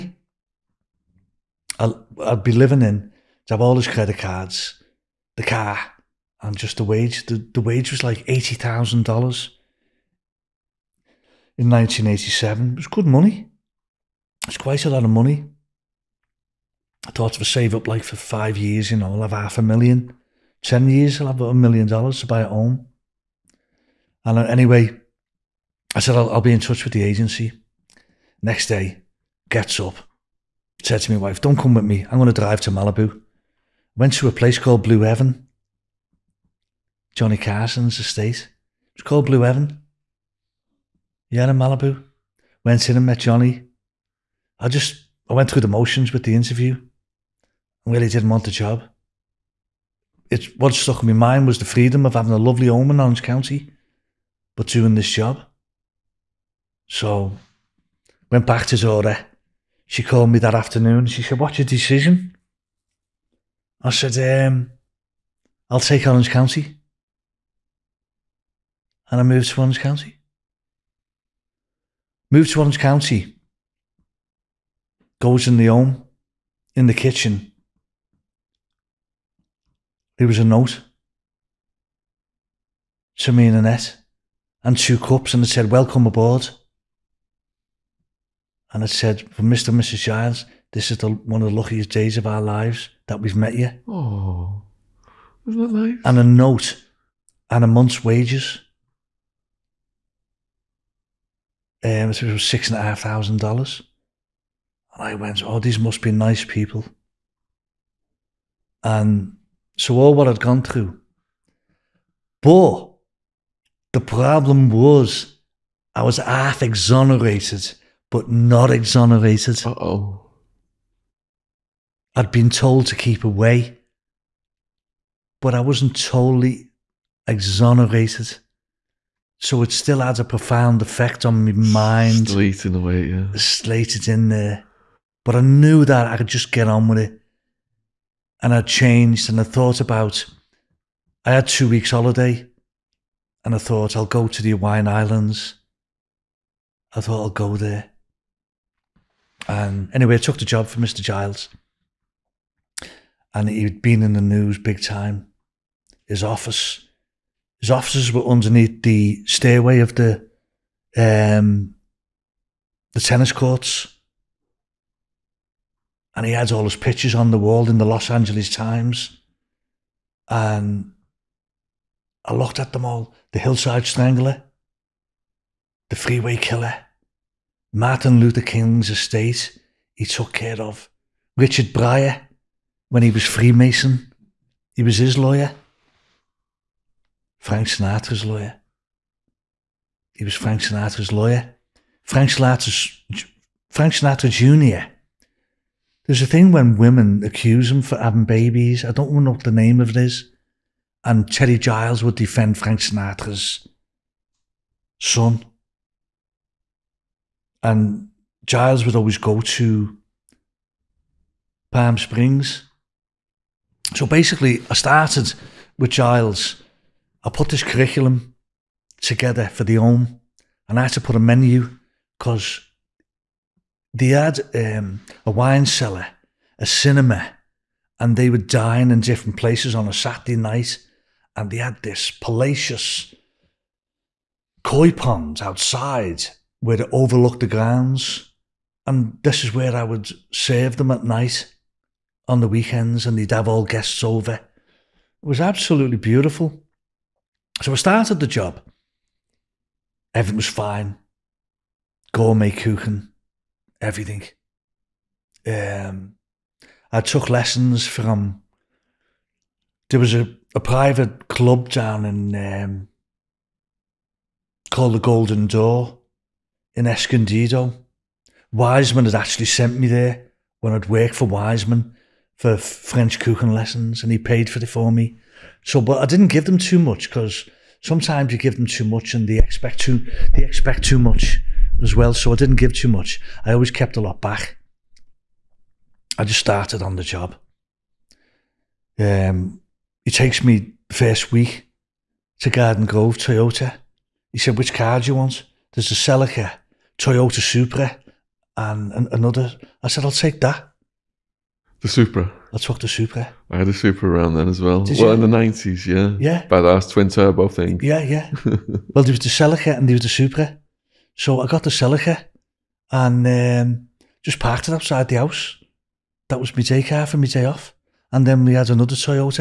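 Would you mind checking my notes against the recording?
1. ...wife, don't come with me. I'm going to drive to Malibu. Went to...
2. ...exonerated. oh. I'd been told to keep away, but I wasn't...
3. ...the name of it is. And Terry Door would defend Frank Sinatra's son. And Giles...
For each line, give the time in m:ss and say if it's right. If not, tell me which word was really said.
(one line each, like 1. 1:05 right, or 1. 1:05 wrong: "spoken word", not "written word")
1. 0:31 right
2. 1:58 right
3. 3:19 wrong: "Giles", not "Door".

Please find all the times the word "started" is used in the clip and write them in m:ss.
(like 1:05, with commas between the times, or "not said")
3:34, 4:07, 4:46.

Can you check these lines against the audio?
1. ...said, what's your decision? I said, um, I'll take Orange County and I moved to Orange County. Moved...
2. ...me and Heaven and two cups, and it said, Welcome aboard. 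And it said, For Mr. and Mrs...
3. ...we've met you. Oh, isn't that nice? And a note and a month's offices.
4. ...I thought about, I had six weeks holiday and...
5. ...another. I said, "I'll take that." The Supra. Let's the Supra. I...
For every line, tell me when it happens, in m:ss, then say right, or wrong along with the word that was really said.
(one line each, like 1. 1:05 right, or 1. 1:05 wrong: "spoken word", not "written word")
1. 1:01 right
2. 1:23 wrong: "Annette", not "Heaven"
3. 1:33 wrong: "wages", not "offices"
4. 2:19 wrong: "two", not "six"
5. 4:59 right.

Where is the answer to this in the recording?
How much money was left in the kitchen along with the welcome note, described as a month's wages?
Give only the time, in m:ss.
1:42.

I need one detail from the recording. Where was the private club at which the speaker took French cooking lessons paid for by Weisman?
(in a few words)
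Escondido.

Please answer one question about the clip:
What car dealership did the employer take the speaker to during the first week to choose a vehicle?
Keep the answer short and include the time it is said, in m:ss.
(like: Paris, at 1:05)
Garden Grove Toyota, at 4:52.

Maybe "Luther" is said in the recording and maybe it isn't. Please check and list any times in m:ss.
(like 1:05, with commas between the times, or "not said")
2:58.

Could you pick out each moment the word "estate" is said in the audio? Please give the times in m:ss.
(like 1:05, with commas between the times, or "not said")
0:37, 2:58.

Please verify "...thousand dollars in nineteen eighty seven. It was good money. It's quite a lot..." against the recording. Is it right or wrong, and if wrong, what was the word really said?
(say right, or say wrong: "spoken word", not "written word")
right.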